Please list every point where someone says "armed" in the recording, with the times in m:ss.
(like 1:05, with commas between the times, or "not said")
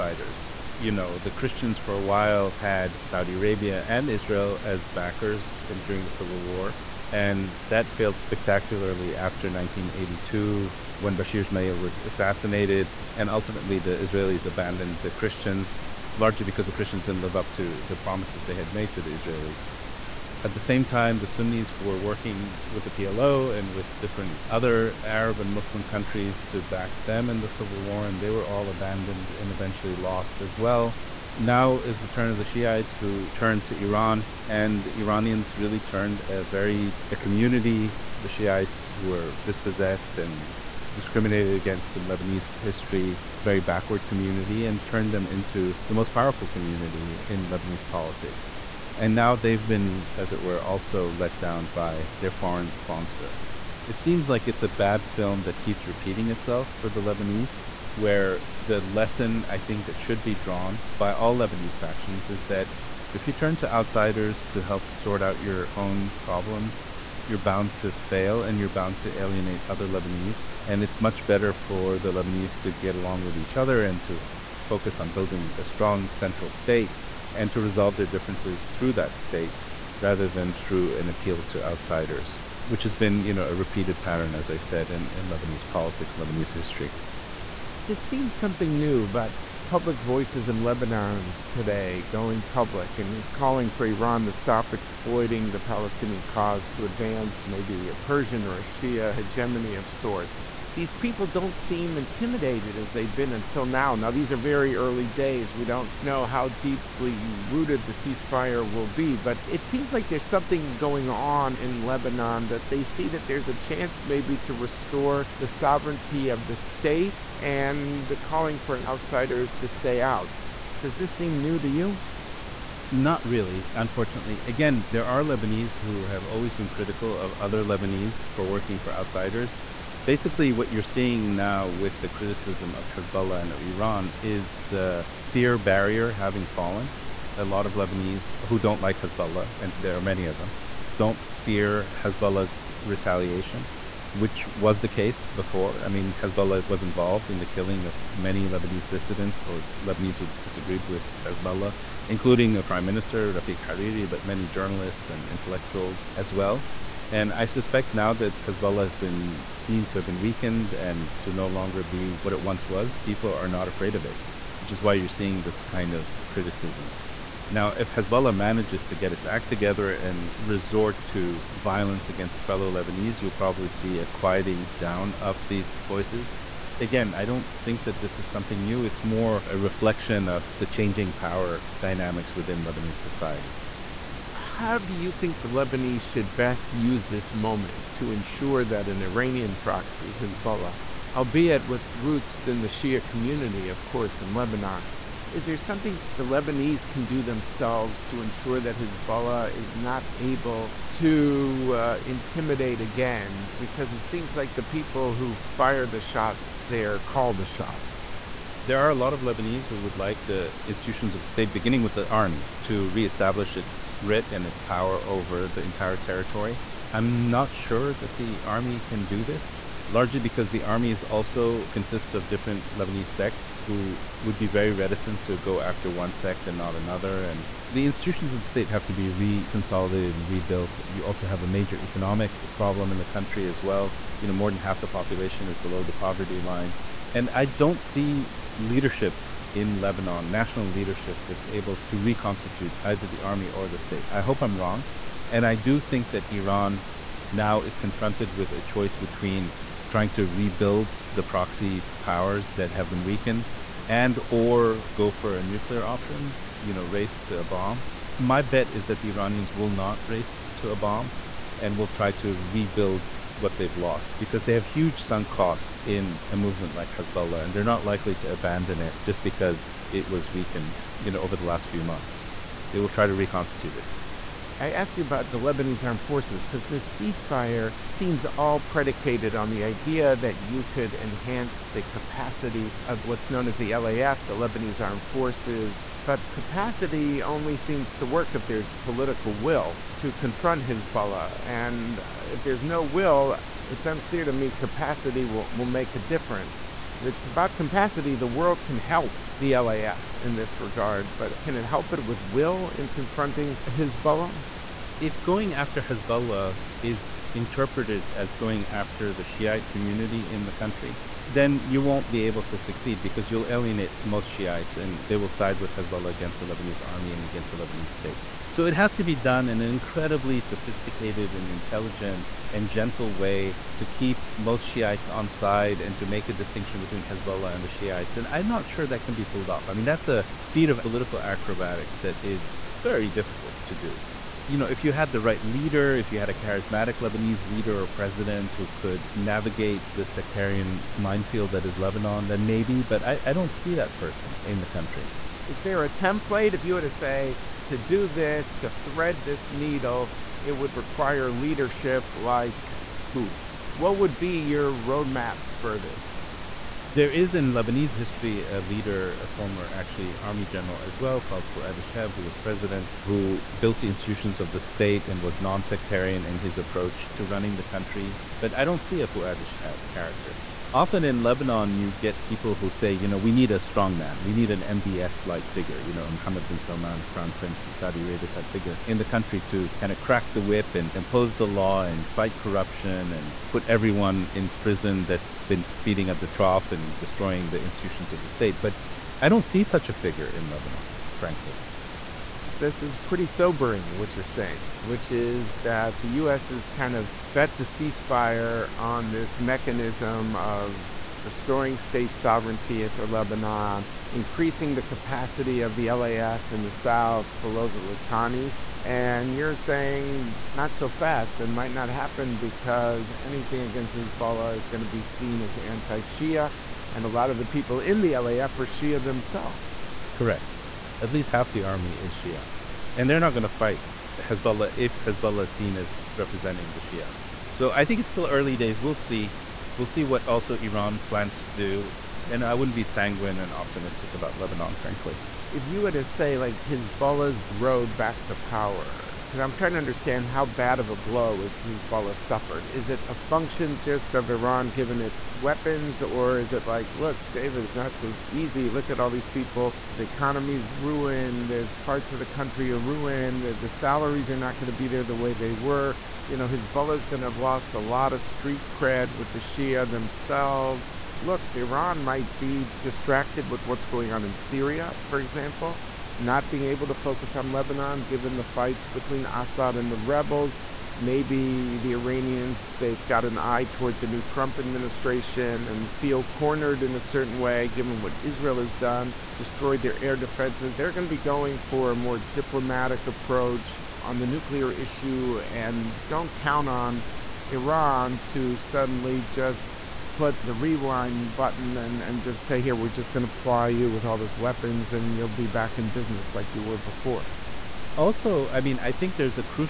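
4:35, 4:44.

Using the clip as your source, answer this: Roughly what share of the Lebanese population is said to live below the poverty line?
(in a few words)
more than half.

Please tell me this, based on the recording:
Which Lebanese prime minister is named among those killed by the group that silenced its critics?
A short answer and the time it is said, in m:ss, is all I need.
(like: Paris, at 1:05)
Rafiq Hariri, at 2:33.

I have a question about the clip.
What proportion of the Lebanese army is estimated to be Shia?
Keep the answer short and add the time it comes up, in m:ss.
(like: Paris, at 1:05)
at least half, at 7:01.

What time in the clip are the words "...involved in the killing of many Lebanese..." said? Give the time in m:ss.
2:26.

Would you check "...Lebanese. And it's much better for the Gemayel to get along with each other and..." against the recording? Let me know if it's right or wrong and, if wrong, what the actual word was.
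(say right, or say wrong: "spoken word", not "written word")
wrong: "Lebanese", not "Gemayel".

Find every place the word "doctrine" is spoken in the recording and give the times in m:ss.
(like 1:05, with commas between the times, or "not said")
not said.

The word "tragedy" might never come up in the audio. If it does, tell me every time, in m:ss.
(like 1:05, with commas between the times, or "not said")
not said.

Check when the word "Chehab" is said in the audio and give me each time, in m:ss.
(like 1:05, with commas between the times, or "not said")
6:01, 6:09.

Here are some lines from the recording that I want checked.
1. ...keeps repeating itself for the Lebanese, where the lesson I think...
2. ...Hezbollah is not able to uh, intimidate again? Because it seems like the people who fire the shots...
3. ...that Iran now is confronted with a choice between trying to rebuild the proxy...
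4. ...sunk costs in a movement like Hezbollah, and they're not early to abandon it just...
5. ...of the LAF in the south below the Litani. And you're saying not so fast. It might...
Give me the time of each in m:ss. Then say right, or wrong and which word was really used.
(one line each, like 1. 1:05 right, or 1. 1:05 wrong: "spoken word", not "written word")
1. 0:55 right
2. 3:18 right
3. 4:06 right
4. 4:25 wrong: "likely", not "early"
5. 6:45 right.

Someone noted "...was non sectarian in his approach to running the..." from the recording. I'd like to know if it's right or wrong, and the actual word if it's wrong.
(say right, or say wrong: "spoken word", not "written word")
right.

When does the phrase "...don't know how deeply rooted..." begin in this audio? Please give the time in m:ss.
1:45.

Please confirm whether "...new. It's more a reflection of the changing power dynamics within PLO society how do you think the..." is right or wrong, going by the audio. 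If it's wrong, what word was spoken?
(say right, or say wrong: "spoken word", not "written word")
wrong: "Lebanese", not "PLO".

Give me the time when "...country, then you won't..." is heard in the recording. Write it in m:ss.
5:10.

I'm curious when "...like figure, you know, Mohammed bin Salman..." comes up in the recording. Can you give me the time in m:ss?
6:15.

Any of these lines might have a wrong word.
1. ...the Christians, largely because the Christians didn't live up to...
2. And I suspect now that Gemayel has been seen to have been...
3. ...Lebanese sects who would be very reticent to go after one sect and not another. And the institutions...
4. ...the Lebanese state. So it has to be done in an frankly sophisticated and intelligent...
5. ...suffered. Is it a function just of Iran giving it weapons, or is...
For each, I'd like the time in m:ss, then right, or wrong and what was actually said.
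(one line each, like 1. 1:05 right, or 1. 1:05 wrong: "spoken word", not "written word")
1. 0:15 right
2. 2:37 wrong: "Hezbollah", not "Gemayel"
3. 3:42 right
4. 5:17 wrong: "incredibly", not "frankly"
5. 7:22 right.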